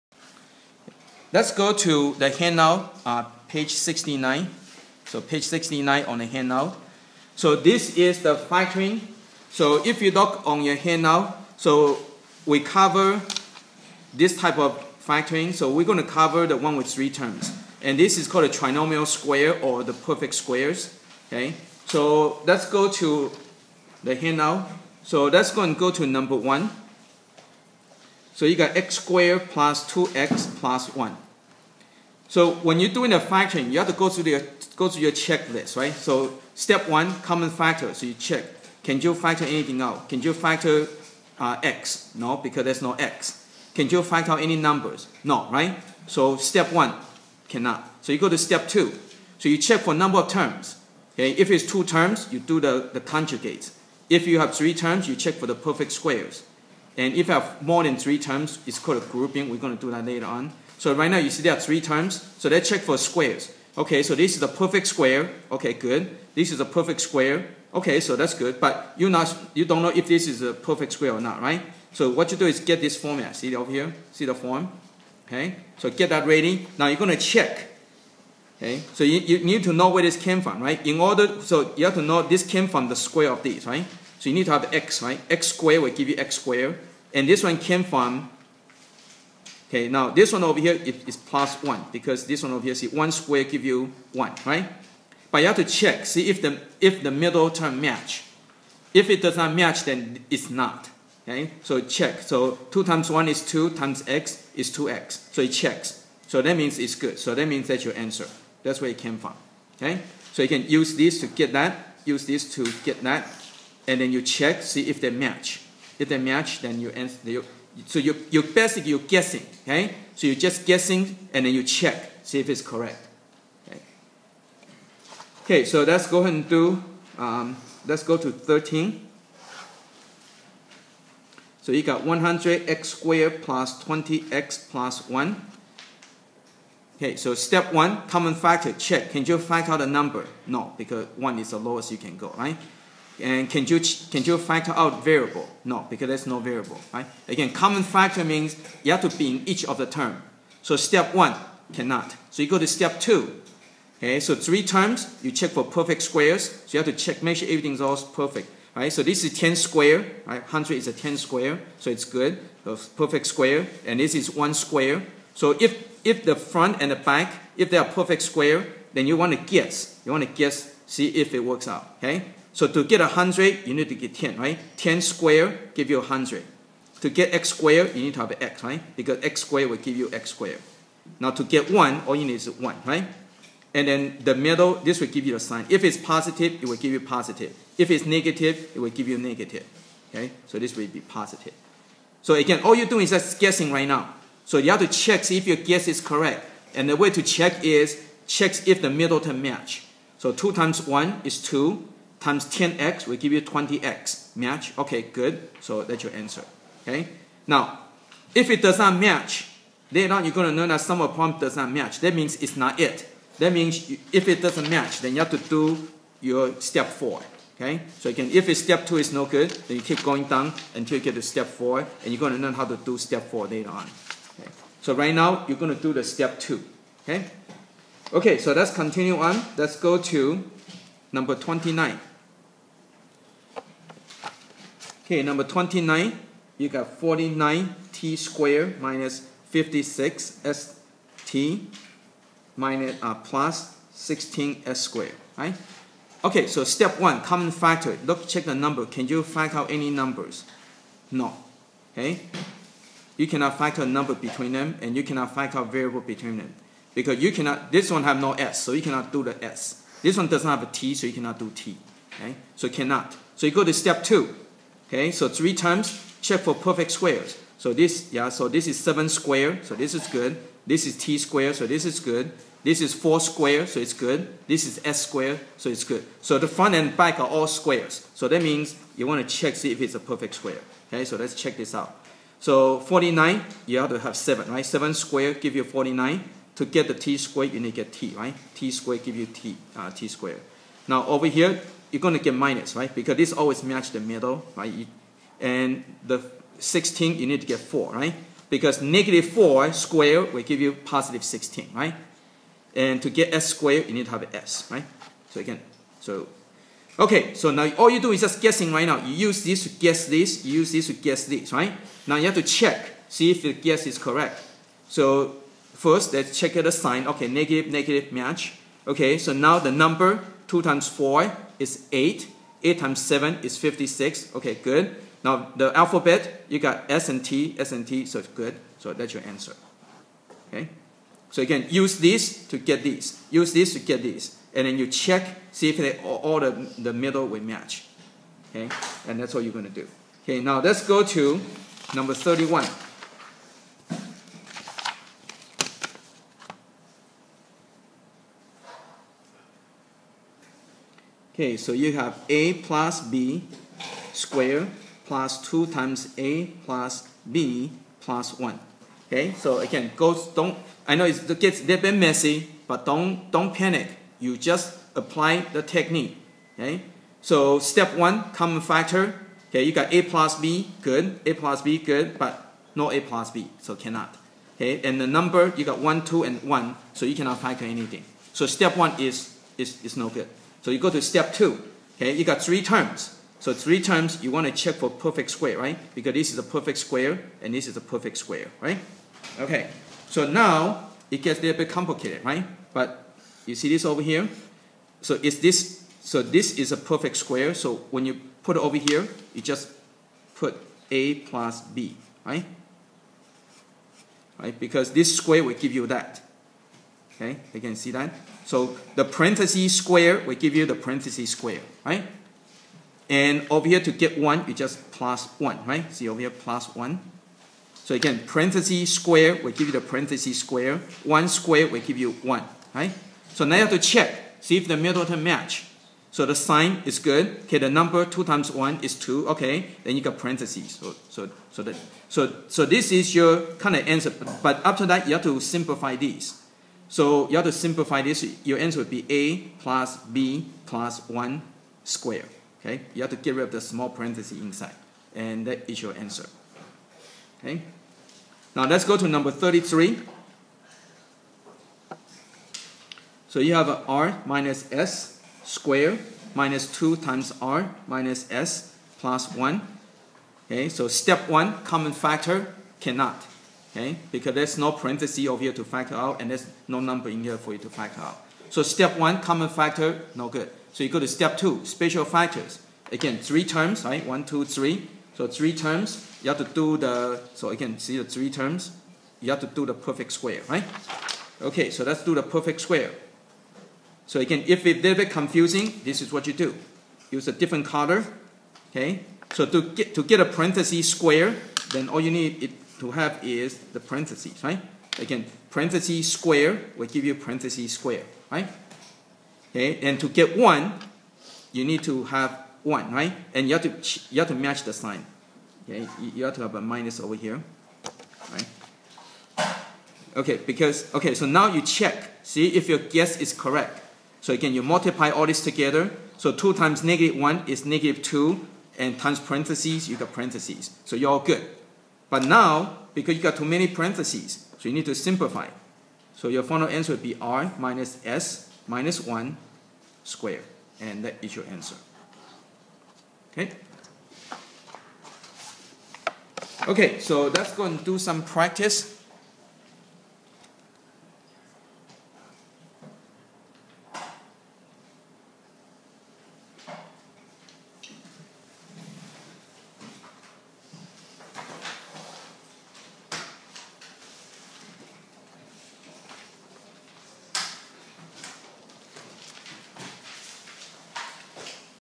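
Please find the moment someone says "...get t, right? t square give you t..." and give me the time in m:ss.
4:47.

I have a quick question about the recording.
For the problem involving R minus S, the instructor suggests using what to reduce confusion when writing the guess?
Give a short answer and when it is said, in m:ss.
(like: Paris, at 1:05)
a different color, at 8:07.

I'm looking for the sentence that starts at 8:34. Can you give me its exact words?
So again, you multiply all this together.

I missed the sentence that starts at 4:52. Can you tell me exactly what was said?
Because this always match the middle, right?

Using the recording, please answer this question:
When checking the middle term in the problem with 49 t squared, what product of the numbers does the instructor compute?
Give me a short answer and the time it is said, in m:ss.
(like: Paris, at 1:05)
56, at 5:22.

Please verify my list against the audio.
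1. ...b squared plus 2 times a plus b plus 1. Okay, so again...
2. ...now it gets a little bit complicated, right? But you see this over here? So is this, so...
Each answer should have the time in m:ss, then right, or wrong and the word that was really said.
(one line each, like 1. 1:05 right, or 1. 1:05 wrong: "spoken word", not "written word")
1. 5:53 right
2. 6:30 right.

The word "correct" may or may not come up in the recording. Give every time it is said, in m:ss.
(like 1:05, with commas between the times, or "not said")
2:02, 3:16, 5:13, 8:33.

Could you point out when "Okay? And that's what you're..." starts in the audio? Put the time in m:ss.
5:38.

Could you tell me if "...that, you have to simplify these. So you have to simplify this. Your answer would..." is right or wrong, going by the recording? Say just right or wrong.
right.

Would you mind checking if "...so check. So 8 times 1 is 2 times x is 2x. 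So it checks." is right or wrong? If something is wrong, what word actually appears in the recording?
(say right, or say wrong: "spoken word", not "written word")
wrong: "2", not "8".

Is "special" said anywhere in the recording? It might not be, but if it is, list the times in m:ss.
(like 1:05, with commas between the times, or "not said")
7:51.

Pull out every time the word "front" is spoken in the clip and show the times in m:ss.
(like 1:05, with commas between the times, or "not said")
2:46, 4:36.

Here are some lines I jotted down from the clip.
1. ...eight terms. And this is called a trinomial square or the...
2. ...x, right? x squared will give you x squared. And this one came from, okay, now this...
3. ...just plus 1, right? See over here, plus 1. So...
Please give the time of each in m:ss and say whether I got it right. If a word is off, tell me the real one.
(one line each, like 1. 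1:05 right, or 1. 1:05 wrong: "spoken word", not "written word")
1. 0:16 wrong: "three", not "eight"
2. 1:24 right
3. 6:54 right.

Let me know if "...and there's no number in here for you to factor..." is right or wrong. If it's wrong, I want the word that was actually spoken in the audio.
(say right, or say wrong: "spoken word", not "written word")
right.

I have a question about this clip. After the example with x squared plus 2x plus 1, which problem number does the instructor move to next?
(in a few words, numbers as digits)
13.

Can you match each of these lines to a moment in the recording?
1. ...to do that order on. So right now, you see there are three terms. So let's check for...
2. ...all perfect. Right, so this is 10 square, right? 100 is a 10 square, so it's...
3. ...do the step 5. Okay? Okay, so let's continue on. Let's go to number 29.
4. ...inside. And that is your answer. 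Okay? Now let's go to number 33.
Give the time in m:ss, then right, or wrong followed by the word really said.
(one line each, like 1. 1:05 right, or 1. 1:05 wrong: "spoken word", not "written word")
1. 0:59 wrong: "later", not "order"
2. 2:37 right
3. 3:45 wrong: "2", not "5"
4. 7:24 right.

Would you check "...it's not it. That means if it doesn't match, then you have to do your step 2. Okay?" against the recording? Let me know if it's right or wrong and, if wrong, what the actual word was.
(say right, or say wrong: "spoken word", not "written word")
wrong: "4", not "2".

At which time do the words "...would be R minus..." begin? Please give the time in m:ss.
8:46.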